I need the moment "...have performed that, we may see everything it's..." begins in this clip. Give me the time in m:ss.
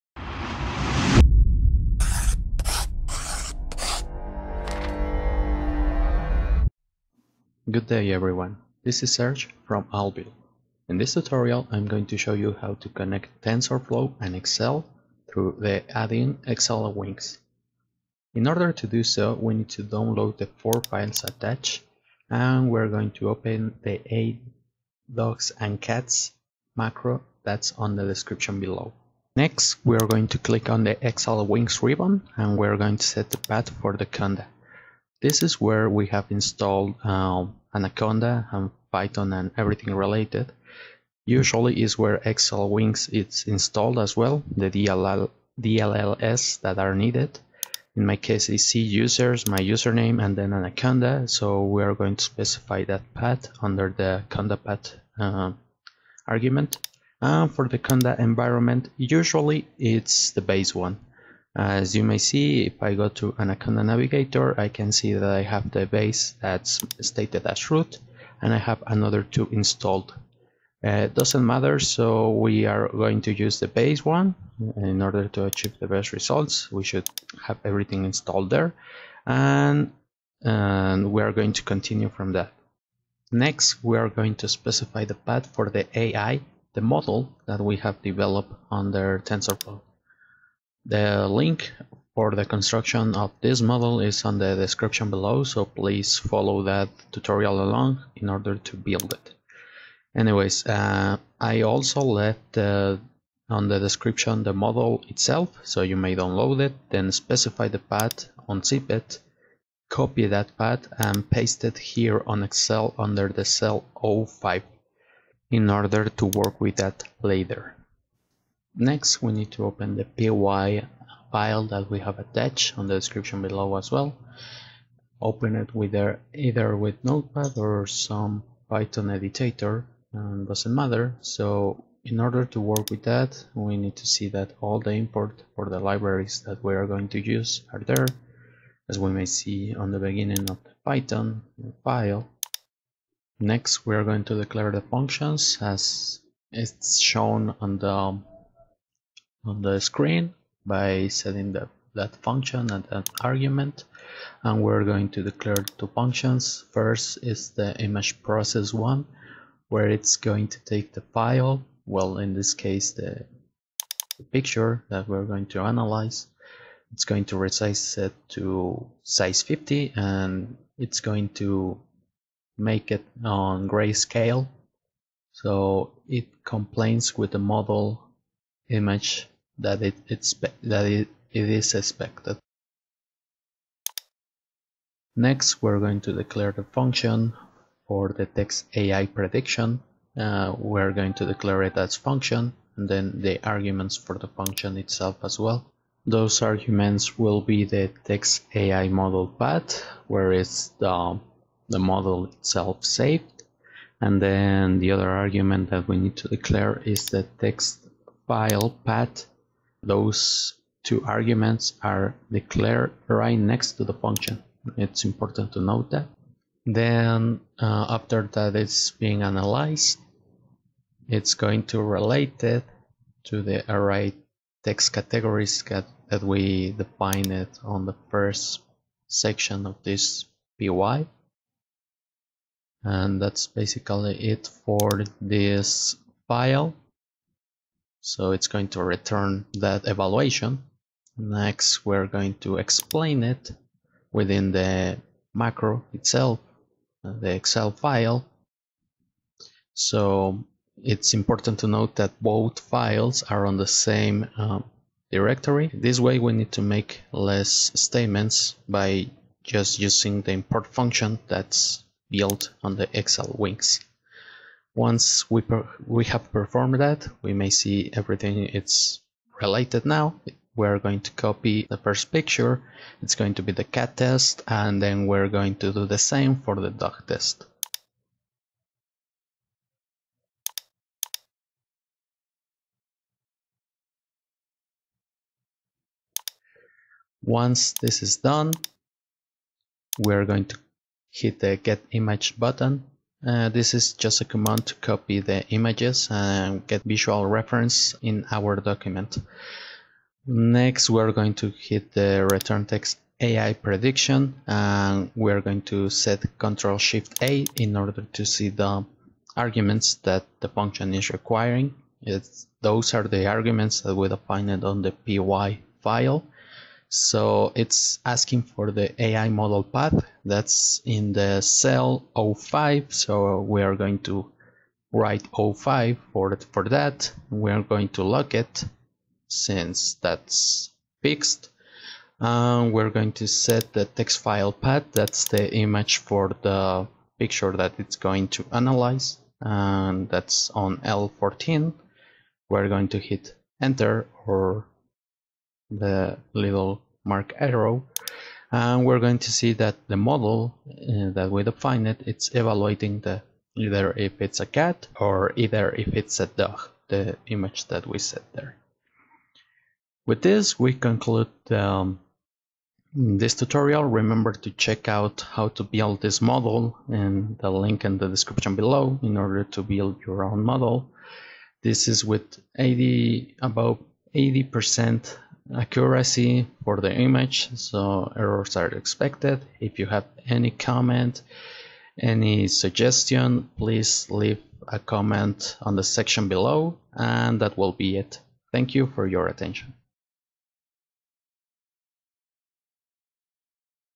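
4:26.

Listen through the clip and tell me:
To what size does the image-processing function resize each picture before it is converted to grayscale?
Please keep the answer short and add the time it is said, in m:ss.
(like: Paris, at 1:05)
50, at 2:49.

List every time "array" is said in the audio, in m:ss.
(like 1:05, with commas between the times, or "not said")
3:43.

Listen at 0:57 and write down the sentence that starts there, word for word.
And for the conda environment, usually it's the base one.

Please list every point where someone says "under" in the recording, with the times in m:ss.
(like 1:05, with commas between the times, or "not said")
0:53, 1:28, 1:52.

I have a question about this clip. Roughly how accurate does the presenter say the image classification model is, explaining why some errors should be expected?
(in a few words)
80 percent.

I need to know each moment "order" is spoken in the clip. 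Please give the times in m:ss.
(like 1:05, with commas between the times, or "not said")
0:18, 1:15, 1:38, 1:55, 2:12, 5:07, 6:09.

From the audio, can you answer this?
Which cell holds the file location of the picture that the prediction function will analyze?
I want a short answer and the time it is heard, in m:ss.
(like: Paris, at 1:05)
L14, at 5:40.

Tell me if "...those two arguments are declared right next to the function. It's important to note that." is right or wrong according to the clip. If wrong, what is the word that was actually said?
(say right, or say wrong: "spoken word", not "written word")
right.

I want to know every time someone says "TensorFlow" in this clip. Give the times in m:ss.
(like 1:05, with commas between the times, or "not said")
0:13, 1:29.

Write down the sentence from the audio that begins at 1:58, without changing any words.
Next, we need to open the py file that we have attached on the description below as well.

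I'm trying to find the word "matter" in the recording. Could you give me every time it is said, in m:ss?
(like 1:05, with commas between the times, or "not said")
1:11, 2:10.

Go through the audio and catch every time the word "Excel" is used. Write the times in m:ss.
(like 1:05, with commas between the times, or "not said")
0:14, 1:52, 4:07.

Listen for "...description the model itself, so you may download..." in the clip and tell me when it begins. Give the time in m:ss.
1:43.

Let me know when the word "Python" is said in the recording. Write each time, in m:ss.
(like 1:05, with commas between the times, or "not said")
0:38, 2:08, 2:20.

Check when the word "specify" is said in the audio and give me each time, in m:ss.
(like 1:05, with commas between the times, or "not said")
0:52, 1:24, 1:47.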